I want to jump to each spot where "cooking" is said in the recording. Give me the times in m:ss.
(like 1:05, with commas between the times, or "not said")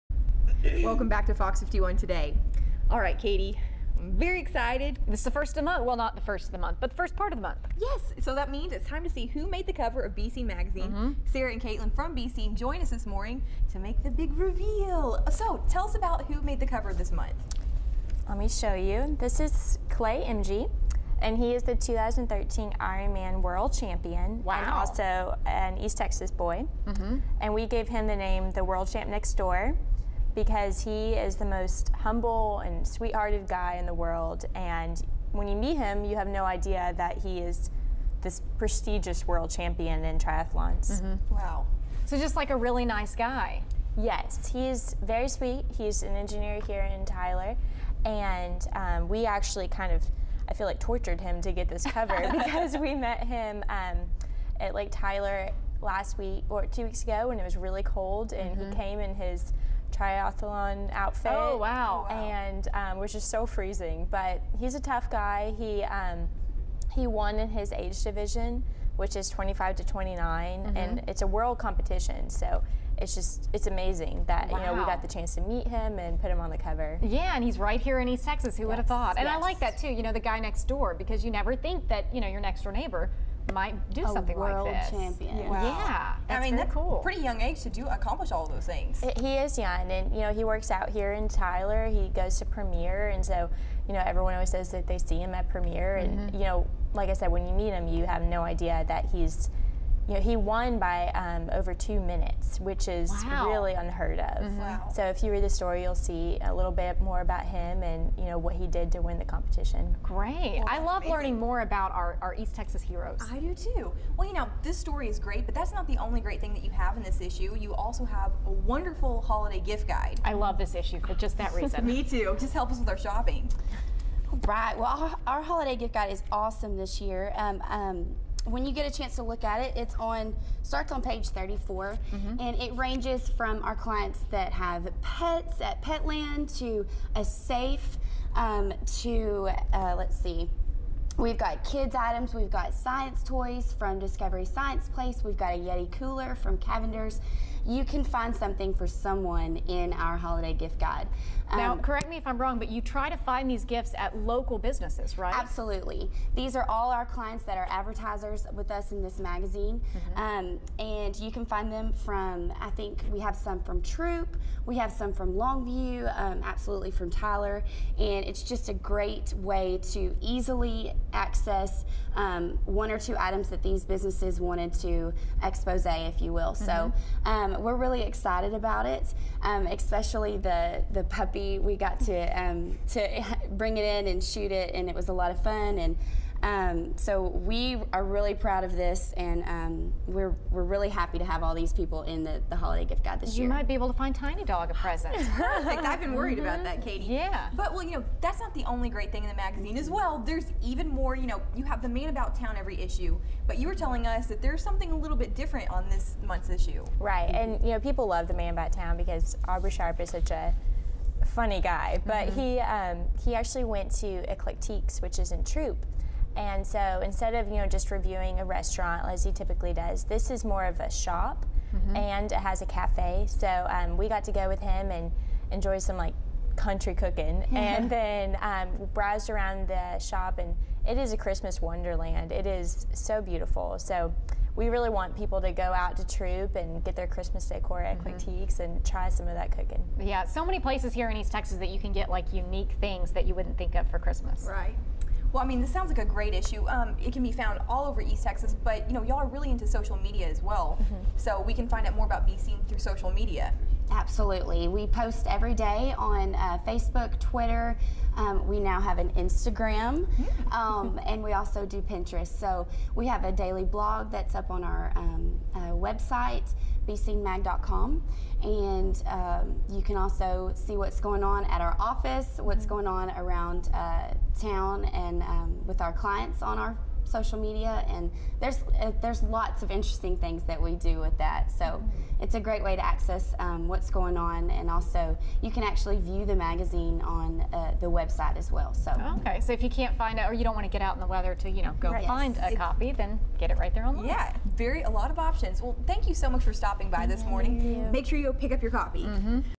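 3:46, 3:59.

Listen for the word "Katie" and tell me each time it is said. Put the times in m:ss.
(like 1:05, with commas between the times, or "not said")
0:03, 3:16.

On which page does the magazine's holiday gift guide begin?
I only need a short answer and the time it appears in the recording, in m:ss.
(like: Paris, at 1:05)
34, at 2:11.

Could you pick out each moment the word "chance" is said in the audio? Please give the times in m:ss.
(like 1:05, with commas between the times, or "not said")
1:15, 2:08.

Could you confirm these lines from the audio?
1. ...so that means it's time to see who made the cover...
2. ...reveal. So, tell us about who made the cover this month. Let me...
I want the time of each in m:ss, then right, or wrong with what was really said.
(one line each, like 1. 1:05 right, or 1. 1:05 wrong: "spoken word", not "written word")
1. 0:08 right
2. 0:14 right.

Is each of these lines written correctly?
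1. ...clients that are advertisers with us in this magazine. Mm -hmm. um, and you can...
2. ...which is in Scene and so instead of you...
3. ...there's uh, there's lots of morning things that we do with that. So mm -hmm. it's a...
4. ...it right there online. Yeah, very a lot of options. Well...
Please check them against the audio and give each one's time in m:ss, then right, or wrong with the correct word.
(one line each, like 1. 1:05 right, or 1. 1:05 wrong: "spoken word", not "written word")
1. 2:37 right
2. 3:35 wrong: "Troup", not "Scene"
3. 4:38 wrong: "interesting", not "morning"
4. 4:53 right.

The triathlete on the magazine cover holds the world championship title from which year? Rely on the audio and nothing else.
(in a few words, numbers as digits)
2013.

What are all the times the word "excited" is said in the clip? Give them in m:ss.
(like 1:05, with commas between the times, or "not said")
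0:04, 2:58.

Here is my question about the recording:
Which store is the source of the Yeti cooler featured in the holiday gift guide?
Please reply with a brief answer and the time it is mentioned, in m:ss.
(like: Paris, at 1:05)
Cavender's, at 2:26.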